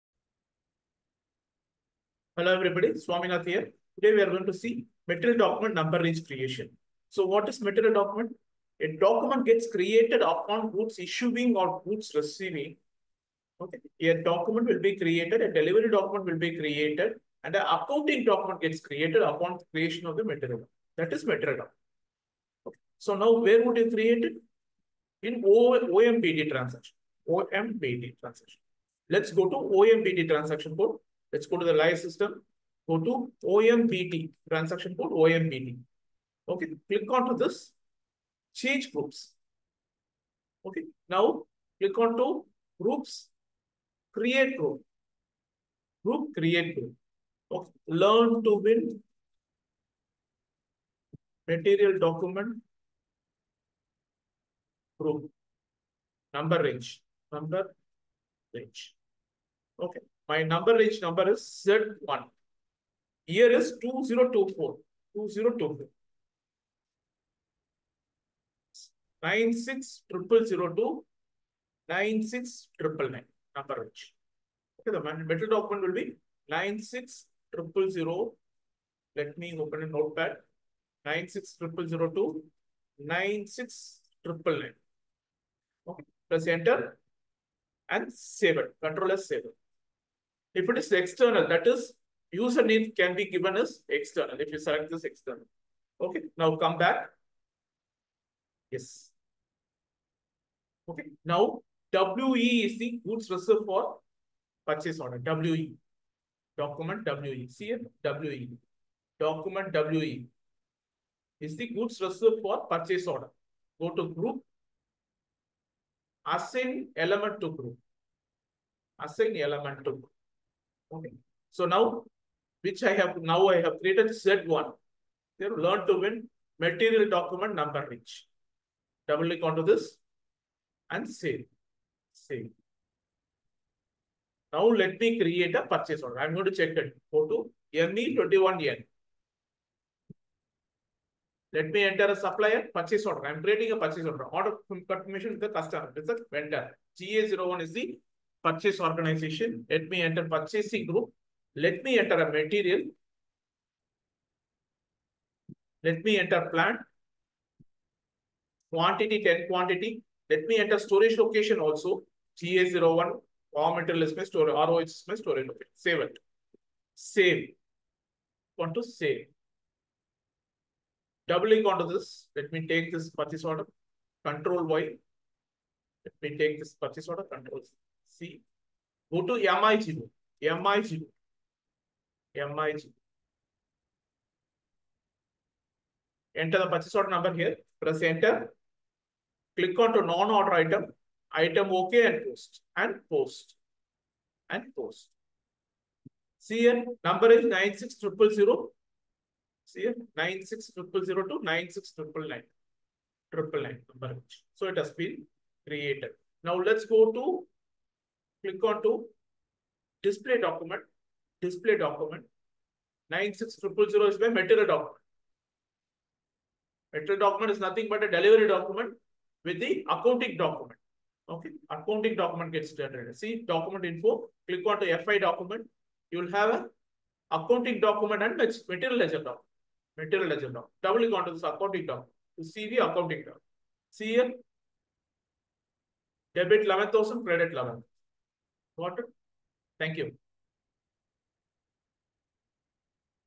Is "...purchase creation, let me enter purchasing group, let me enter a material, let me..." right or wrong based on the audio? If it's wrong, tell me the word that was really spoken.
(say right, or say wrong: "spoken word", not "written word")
wrong: "organization", not "creation".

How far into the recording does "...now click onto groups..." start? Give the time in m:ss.
0:41.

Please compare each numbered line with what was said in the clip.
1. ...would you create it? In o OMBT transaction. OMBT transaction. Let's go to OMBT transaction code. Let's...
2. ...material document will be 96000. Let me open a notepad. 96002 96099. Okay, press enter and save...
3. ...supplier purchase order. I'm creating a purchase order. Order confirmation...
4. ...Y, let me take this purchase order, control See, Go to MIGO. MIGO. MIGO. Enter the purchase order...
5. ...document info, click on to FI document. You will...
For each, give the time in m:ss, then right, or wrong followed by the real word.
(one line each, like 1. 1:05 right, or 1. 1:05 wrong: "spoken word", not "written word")
1. 0:23 right
2. 1:15 wrong: "metal", not "material"
3. 2:22 right
4. 2:54 right
5. 3:43 right.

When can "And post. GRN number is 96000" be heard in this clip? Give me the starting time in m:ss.
3:14.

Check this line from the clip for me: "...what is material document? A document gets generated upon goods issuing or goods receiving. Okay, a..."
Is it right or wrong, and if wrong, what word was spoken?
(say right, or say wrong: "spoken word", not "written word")
wrong: "created", not "generated".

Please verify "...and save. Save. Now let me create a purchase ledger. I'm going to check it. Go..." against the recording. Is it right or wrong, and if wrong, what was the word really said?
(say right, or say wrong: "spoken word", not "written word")
wrong: "order", not "ledger".